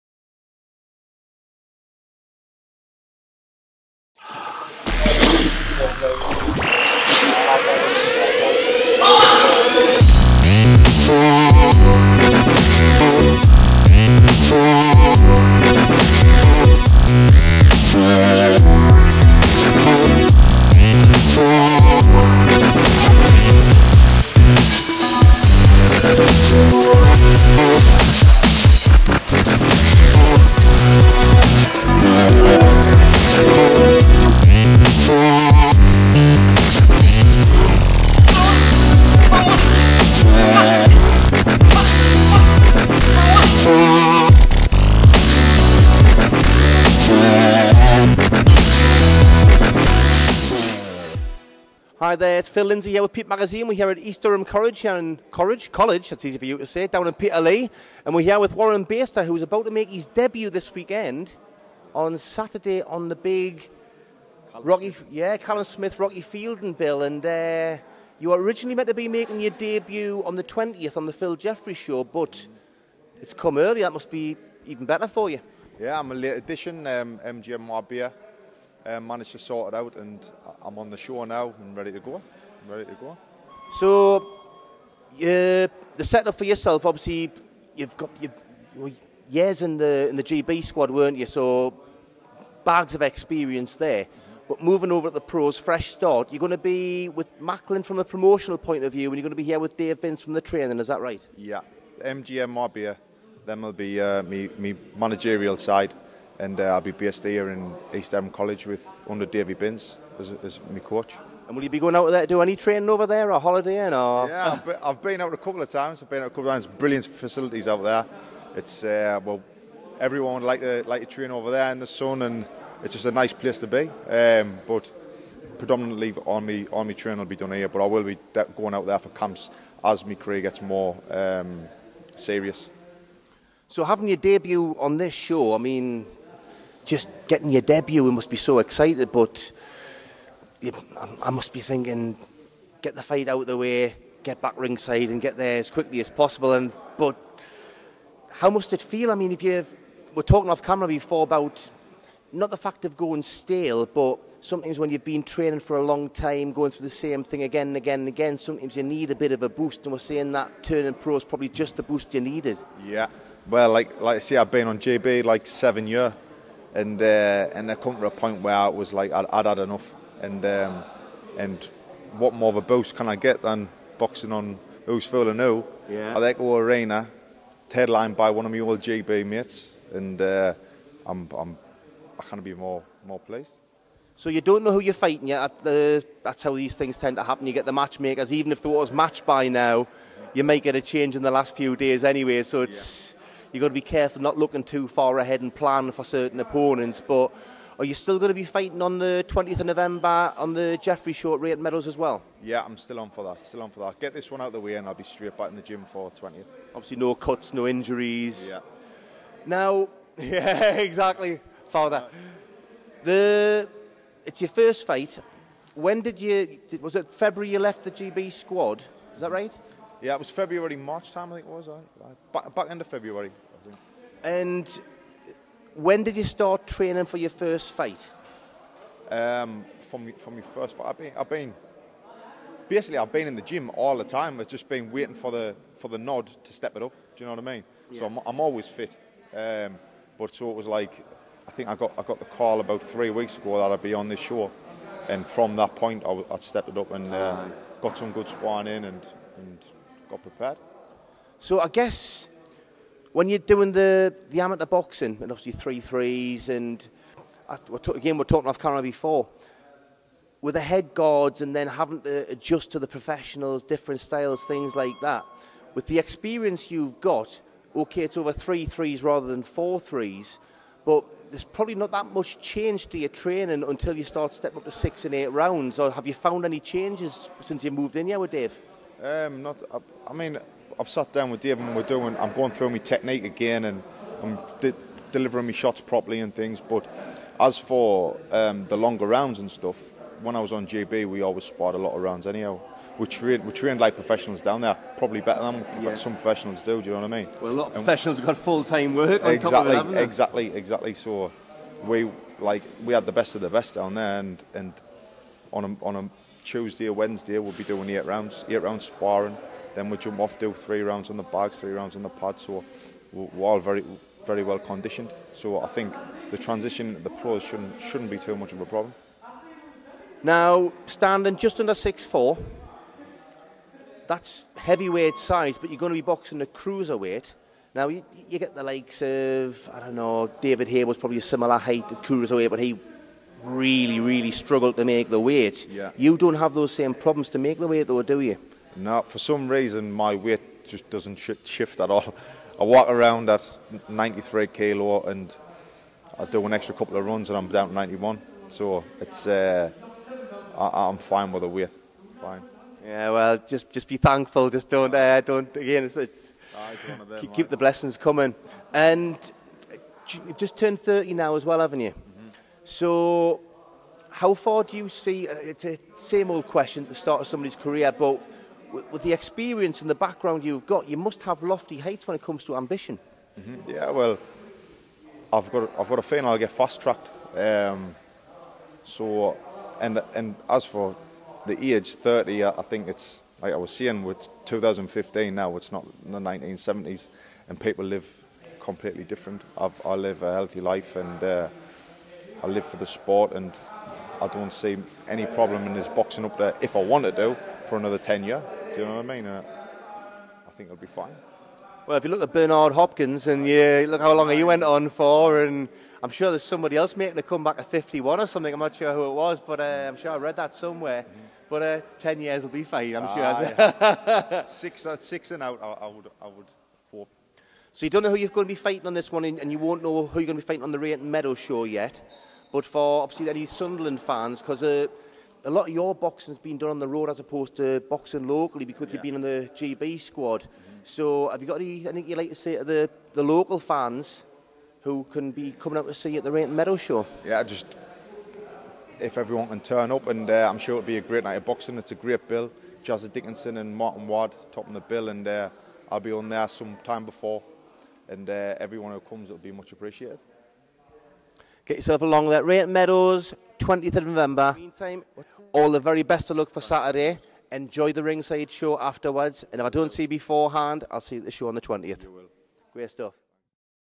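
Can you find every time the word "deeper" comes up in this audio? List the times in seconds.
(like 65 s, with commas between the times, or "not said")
not said.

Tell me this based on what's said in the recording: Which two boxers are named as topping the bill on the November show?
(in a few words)
Jazza Dickinson and Martin Ward.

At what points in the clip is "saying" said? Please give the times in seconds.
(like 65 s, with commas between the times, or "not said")
159 s, 383 s.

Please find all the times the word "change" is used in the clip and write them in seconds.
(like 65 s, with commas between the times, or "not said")
190 s, 272 s, 276 s.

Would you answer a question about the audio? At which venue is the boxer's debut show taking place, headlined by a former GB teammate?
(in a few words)
Echo Arena.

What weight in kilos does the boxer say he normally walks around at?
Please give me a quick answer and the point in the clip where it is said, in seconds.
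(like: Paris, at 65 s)
93, at 343 s.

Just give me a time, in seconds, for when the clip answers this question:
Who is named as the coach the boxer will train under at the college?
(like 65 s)
109 s.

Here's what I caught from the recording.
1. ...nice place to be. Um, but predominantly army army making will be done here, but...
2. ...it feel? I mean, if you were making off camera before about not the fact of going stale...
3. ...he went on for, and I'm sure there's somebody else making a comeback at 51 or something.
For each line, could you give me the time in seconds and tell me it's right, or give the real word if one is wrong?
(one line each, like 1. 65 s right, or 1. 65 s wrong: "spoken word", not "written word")
1. 123 s wrong: "training", not "making"
2. 148 s wrong: "talking", not "making"
3. 404 s right.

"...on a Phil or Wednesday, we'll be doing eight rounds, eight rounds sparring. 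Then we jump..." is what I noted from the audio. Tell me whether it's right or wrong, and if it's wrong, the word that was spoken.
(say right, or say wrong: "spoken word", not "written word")
wrong: "Tuesday", not "Phil".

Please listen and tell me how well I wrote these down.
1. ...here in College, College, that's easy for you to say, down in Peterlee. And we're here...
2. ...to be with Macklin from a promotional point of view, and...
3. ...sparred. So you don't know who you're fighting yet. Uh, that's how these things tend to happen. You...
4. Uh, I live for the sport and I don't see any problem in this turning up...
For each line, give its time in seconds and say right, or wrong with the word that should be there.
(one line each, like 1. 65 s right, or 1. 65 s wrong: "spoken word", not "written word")
1. 54 s right
2. 96 s right
3. 183 s wrong: "pleased", not "sparred"
4. 391 s wrong: "boxing", not "turning".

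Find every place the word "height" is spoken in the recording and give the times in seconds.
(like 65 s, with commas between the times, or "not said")
331 s, 371 s.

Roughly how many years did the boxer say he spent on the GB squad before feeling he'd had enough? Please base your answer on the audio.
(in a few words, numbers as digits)
7.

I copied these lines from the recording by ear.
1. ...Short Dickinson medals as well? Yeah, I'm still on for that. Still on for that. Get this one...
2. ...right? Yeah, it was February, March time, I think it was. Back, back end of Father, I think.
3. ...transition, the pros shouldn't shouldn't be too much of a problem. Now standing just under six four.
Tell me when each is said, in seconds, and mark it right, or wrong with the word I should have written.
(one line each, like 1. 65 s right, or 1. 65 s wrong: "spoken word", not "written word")
1. 201 s wrong: "Rate", not "Dickinson"
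2. 219 s wrong: "February", not "Father"
3. 316 s right.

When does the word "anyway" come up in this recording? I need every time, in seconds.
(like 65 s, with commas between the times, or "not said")
192 s.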